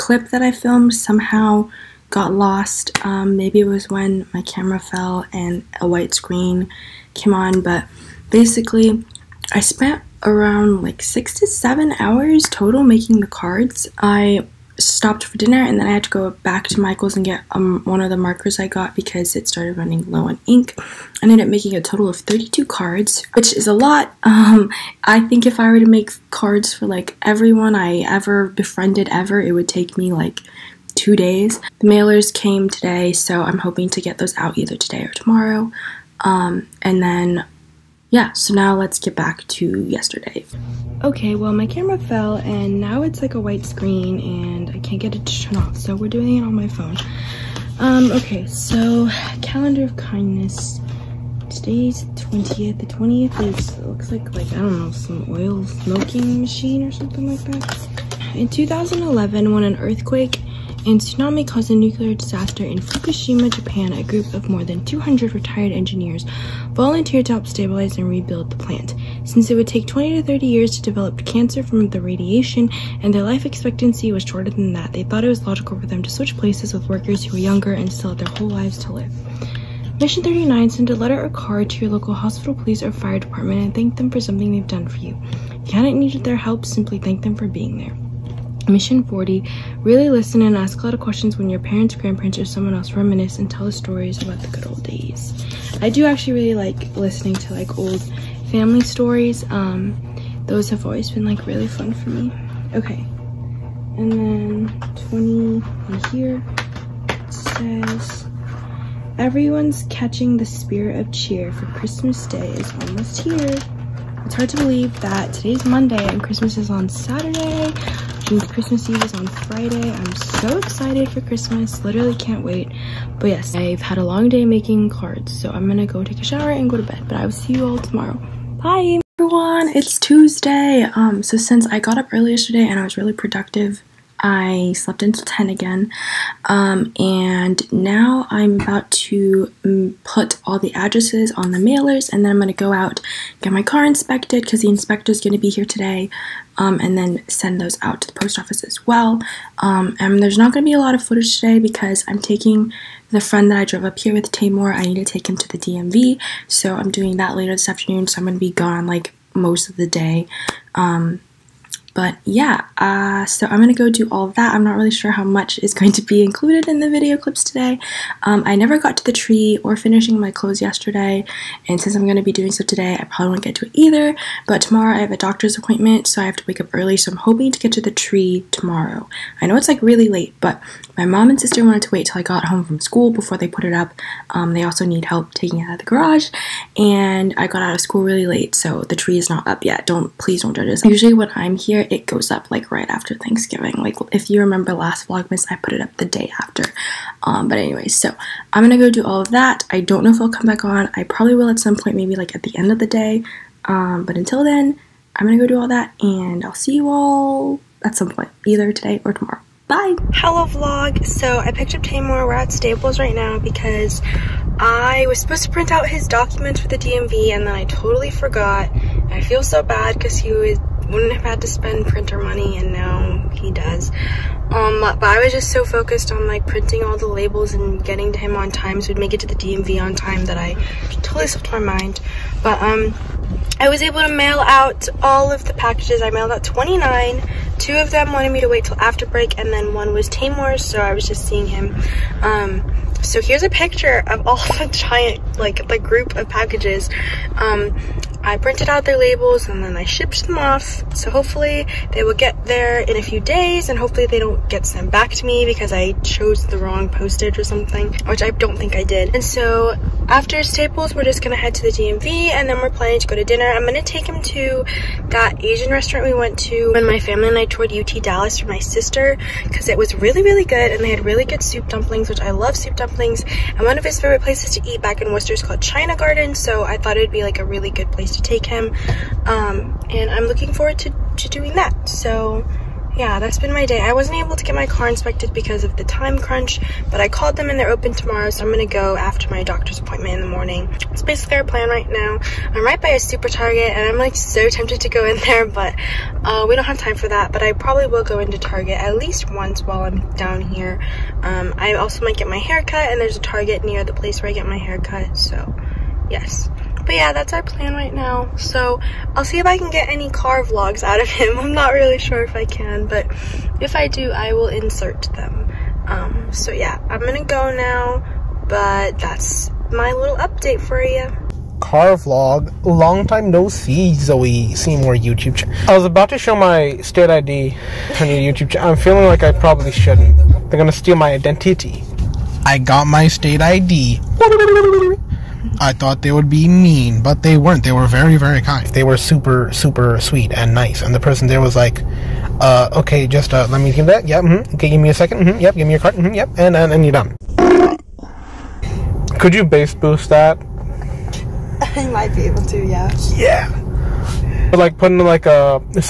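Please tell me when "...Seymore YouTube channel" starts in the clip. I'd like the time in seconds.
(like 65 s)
324 s.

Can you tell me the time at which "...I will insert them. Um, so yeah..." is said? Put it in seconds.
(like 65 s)
314 s.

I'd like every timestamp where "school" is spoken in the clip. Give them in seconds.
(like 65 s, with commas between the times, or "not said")
182 s, 187 s.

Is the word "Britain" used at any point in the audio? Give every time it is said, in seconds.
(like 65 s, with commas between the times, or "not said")
not said.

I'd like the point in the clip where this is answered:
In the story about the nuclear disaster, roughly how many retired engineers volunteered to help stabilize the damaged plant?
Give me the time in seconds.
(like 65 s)
64 s.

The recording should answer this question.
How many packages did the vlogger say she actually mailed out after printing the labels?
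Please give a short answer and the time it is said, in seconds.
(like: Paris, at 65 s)
29, at 236 s.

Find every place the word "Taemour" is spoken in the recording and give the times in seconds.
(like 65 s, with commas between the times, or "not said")
154 s, 211 s, 240 s.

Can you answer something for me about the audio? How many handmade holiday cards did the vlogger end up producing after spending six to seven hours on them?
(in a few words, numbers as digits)
32.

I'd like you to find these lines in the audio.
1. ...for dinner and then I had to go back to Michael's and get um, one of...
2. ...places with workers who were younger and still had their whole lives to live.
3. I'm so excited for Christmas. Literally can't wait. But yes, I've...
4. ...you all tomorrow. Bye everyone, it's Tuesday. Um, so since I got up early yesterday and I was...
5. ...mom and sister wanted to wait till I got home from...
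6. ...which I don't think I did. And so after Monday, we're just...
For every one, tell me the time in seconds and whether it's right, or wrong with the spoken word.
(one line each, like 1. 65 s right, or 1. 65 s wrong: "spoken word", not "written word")
1. 15 s right
2. 76 s right
3. 119 s right
4. 127 s right
5. 181 s right
6. 258 s wrong: "Staples", not "Monday".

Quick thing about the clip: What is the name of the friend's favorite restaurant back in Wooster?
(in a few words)
China Garden.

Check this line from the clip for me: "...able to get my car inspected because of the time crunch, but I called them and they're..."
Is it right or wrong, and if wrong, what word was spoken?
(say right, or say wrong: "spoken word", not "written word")
right.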